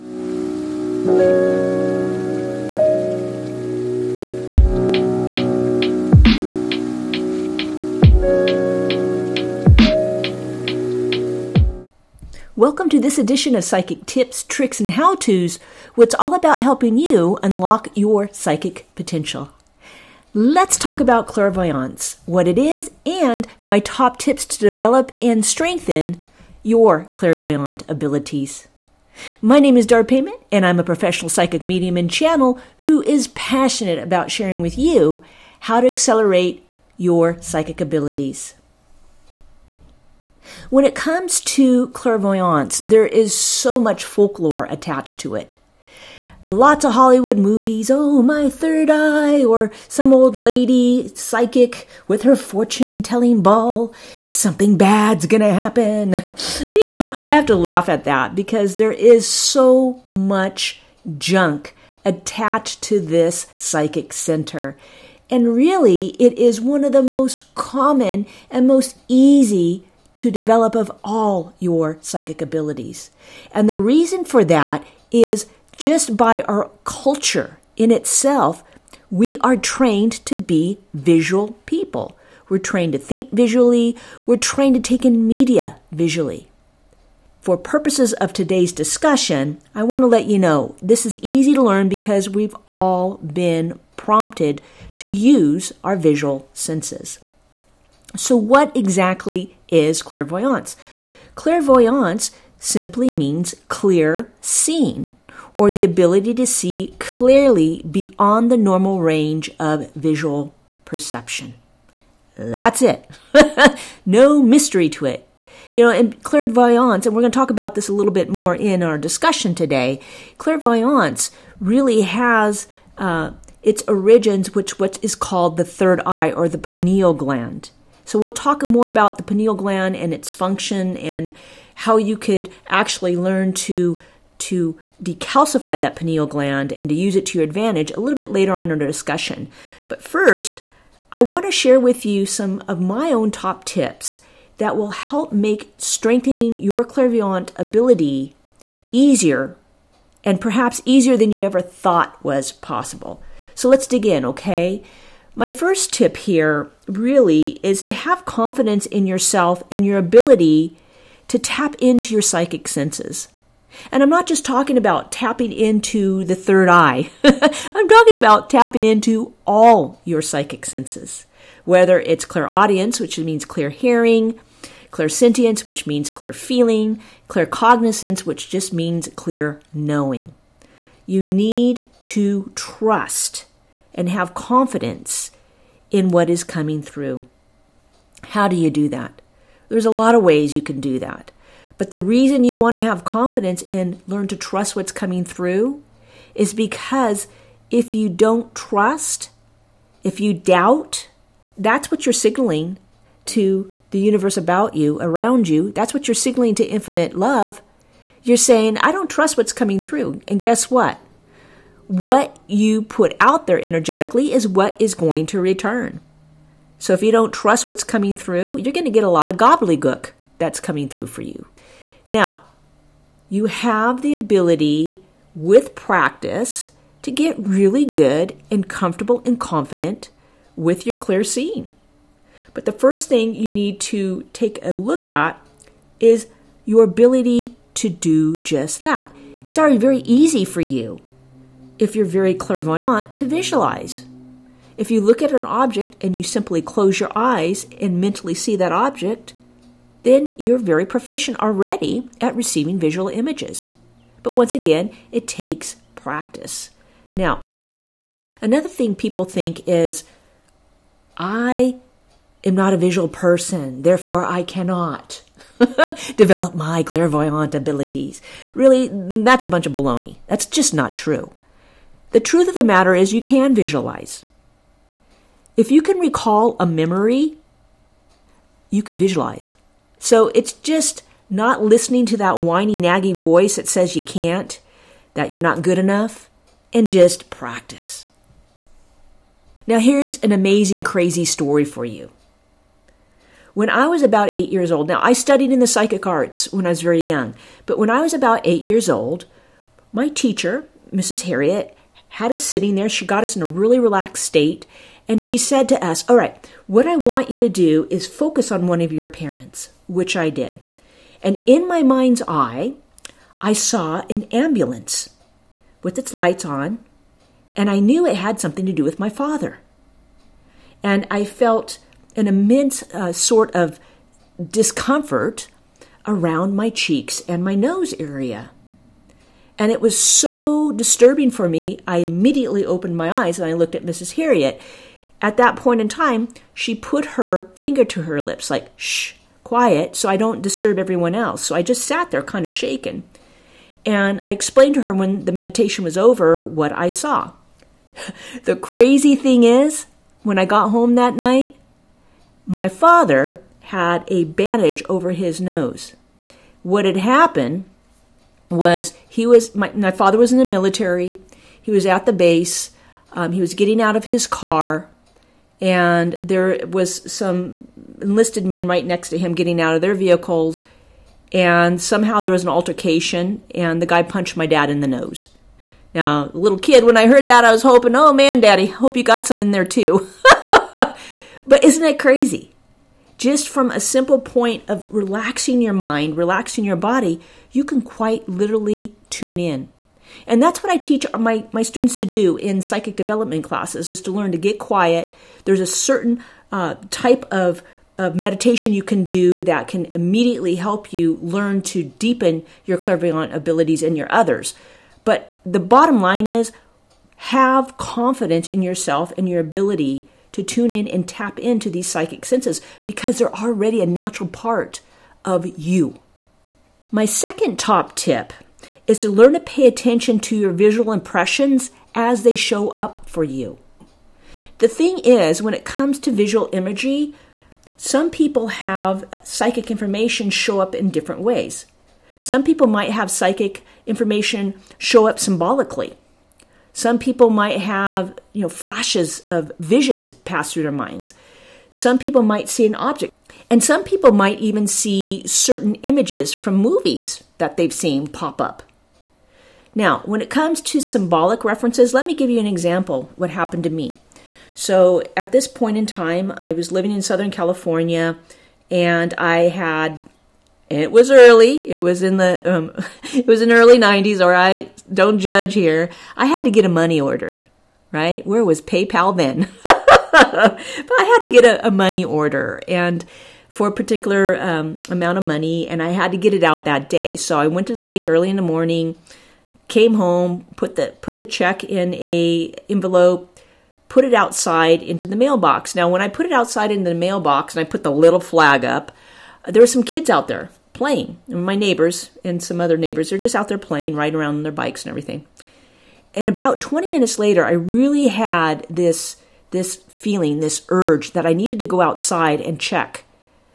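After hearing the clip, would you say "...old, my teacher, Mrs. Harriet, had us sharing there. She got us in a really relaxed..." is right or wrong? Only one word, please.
wrong.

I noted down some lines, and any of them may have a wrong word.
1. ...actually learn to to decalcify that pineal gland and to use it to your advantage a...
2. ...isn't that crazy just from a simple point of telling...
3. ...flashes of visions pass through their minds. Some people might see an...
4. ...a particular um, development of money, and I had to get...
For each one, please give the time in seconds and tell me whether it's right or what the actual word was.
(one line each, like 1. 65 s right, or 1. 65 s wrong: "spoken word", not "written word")
1. 132 s right
2. 381 s wrong: "relaxing", not "telling"
3. 438 s right
4. 473 s wrong: "amount", not "development".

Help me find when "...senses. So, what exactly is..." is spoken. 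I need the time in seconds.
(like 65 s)
96 s.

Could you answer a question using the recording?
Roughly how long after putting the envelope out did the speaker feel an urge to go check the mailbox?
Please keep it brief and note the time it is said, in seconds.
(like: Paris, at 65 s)
20 minutes, at 496 s.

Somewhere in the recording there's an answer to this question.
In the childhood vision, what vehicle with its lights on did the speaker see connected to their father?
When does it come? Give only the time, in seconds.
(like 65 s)
314 s.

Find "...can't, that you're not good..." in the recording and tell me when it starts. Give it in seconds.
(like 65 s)
284 s.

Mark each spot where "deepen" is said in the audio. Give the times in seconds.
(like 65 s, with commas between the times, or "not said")
401 s.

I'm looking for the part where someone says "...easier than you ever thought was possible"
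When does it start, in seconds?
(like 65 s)
150 s.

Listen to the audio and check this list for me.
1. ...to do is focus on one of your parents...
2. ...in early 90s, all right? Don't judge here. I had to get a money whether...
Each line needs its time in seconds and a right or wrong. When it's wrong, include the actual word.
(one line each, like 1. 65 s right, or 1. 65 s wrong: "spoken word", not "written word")
1. 307 s right
2. 463 s wrong: "order", not "whether".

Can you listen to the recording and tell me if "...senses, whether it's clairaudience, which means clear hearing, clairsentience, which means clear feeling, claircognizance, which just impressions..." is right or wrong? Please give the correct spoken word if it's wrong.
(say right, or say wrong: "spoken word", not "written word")
wrong: "means", not "impressions".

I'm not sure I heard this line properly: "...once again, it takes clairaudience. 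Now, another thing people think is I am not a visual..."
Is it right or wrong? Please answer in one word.
wrong.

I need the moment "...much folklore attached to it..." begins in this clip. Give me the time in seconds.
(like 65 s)
43 s.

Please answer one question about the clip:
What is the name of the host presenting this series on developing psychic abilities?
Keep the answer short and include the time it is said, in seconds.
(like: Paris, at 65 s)
Dar Payment, at 29 s.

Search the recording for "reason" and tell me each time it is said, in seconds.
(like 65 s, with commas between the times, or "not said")
73 s, 191 s.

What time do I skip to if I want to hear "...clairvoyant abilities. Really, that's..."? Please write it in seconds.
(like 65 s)
266 s.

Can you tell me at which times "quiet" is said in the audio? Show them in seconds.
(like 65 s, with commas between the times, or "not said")
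339 s, 394 s.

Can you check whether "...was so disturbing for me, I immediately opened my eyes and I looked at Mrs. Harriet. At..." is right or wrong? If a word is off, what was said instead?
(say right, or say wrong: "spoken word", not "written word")
right.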